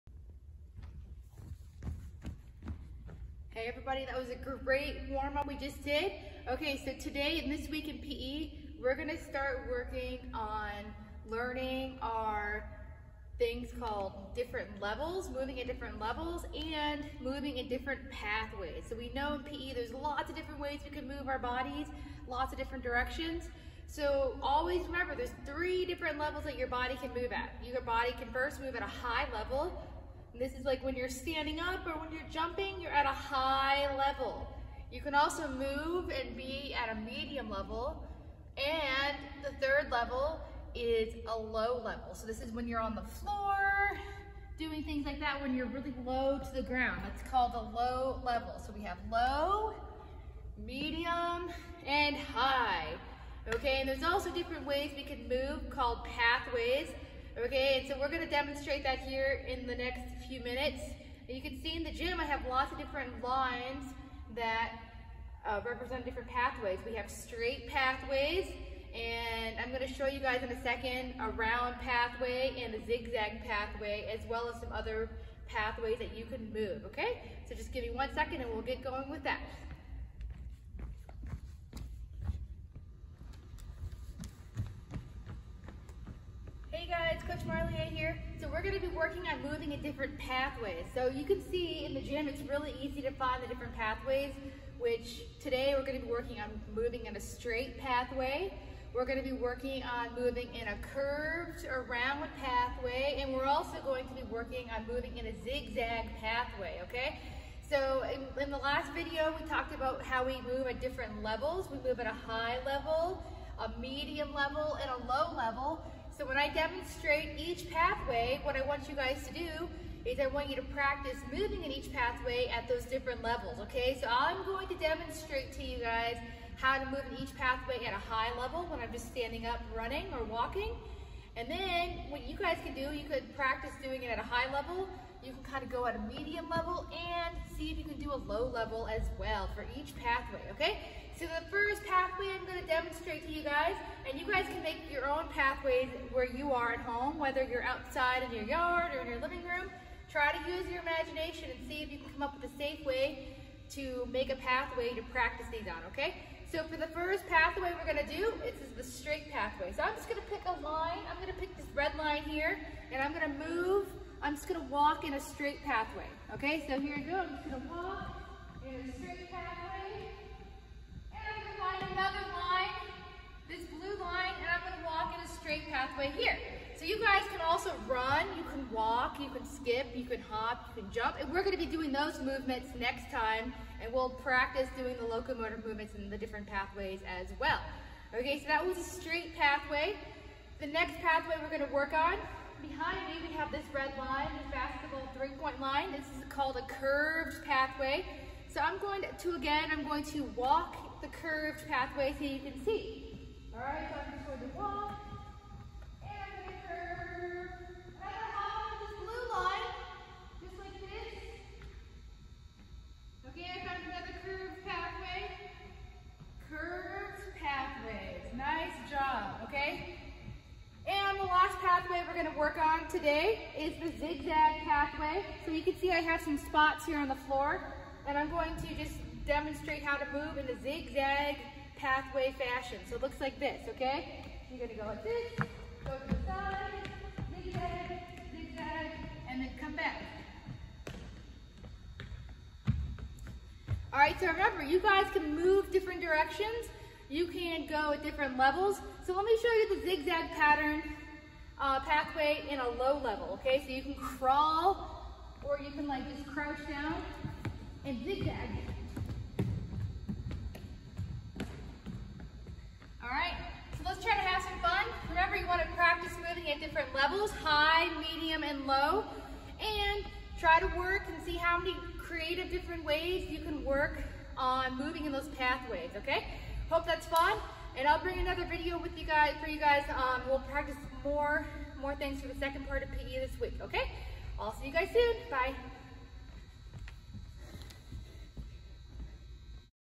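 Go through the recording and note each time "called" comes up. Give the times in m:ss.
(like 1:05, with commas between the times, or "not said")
0:13, 0:47, 0:55, 3:16.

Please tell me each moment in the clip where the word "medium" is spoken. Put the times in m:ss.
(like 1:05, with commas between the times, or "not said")
0:37, 0:50, 1:53, 2:16, 4:27.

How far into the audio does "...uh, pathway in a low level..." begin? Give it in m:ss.
4:11.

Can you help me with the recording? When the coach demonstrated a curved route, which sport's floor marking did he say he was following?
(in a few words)
Basketball three-point line.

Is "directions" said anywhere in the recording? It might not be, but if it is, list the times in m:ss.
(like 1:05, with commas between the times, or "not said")
0:22, 4:06.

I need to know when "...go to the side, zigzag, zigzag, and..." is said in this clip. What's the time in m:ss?
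3:55.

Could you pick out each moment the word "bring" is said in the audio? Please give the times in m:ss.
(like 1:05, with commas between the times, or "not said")
4:38.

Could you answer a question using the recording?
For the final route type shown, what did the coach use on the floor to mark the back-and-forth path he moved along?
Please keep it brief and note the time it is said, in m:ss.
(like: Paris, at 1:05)
Spots, at 3:46.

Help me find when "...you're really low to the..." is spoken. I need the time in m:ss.
0:45.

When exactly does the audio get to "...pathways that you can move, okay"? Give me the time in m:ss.
1:15.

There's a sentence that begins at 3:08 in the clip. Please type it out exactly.
Okay, so that was a straight pathway.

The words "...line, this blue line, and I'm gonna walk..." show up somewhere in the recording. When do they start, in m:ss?
2:52.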